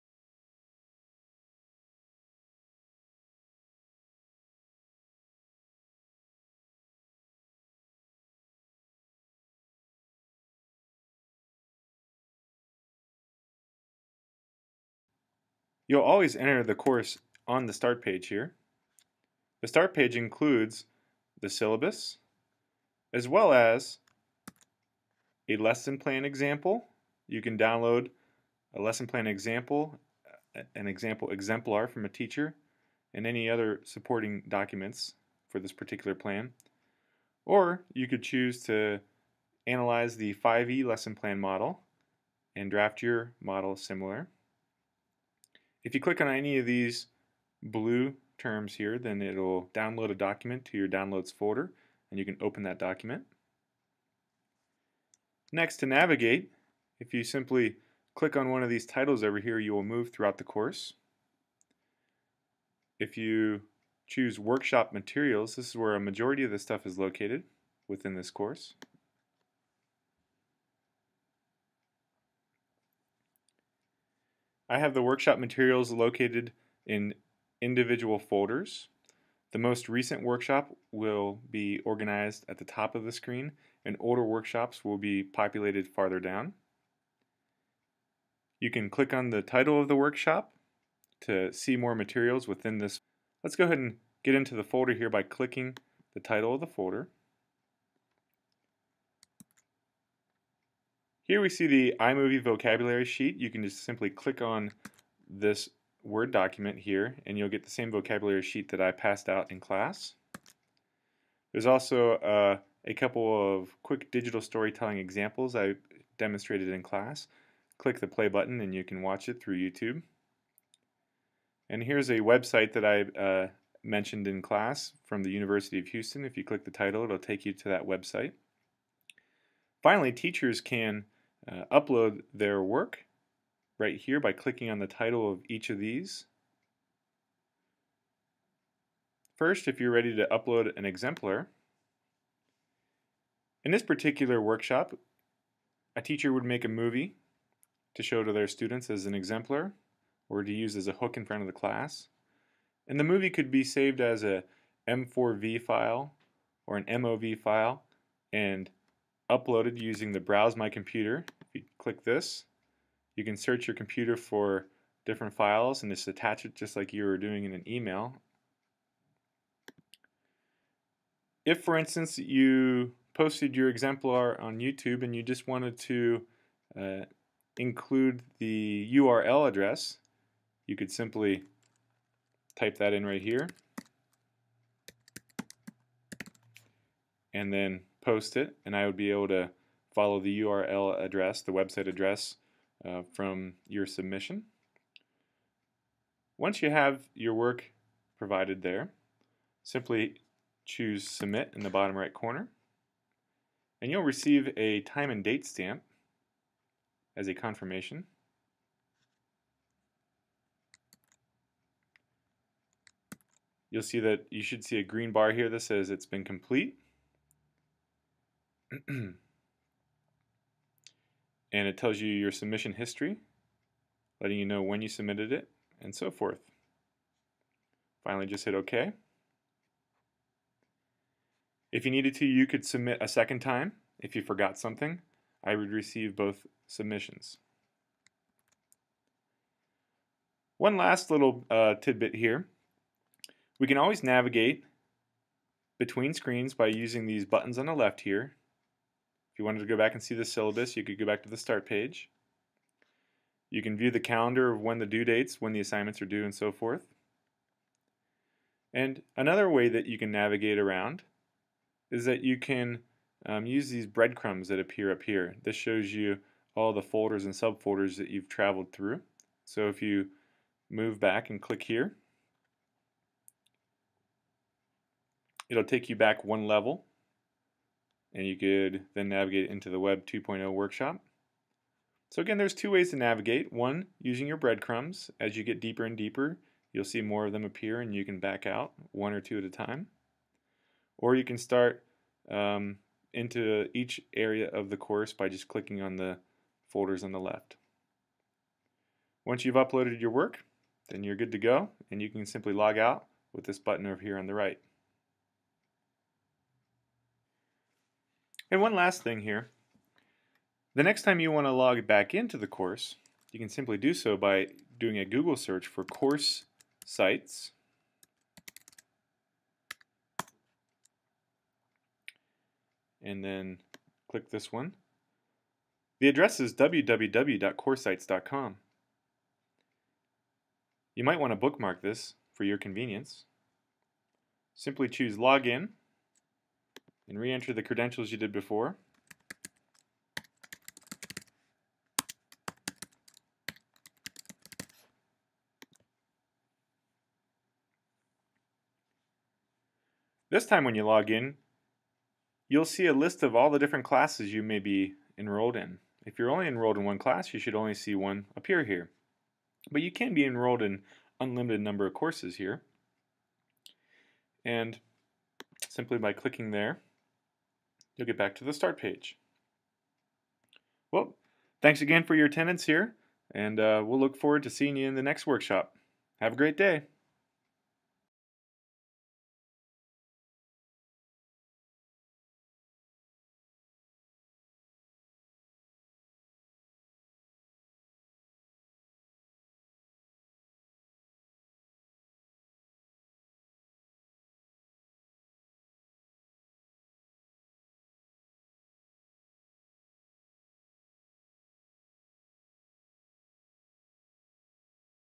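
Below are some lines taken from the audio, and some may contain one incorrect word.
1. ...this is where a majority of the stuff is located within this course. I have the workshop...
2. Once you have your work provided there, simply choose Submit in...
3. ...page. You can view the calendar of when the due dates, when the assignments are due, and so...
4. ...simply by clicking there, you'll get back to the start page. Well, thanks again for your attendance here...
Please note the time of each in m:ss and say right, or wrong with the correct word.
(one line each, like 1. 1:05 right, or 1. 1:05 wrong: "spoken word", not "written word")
1. 1:05 right
2. 3:16 right
3. 4:11 right
4. 6:05 right.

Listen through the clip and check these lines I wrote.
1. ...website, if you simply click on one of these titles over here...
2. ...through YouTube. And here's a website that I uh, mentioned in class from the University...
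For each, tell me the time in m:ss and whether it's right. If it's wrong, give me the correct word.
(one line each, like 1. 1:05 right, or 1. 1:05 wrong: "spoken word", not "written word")
1. 0:55 wrong: "navigate", not "website"
2. 1:59 right.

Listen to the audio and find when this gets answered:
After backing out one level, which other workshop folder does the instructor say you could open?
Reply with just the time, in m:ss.
4:39.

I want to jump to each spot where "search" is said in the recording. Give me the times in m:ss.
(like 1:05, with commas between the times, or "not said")
2:43, 5:15.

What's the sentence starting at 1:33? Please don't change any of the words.
Let's go ahead and get into the folder here by clicking the title of the folder.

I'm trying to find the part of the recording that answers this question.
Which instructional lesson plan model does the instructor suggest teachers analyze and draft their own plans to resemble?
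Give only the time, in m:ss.
0:40.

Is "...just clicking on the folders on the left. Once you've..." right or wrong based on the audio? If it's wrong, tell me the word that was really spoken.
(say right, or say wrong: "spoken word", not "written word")
right.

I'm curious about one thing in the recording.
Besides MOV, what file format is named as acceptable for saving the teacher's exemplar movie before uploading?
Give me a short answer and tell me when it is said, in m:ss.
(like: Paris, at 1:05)
M4V, at 2:34.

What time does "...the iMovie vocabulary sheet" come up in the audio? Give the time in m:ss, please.
1:41.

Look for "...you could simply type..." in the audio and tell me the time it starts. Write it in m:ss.
3:00.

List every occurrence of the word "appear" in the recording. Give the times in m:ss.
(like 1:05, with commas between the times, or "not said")
4:24, 4:47, 5:58.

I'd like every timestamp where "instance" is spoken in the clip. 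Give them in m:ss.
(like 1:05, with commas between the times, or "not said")
2:51.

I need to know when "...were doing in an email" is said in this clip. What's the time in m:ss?
2:47.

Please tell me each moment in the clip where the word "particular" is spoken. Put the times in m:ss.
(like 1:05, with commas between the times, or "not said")
0:35, 2:23.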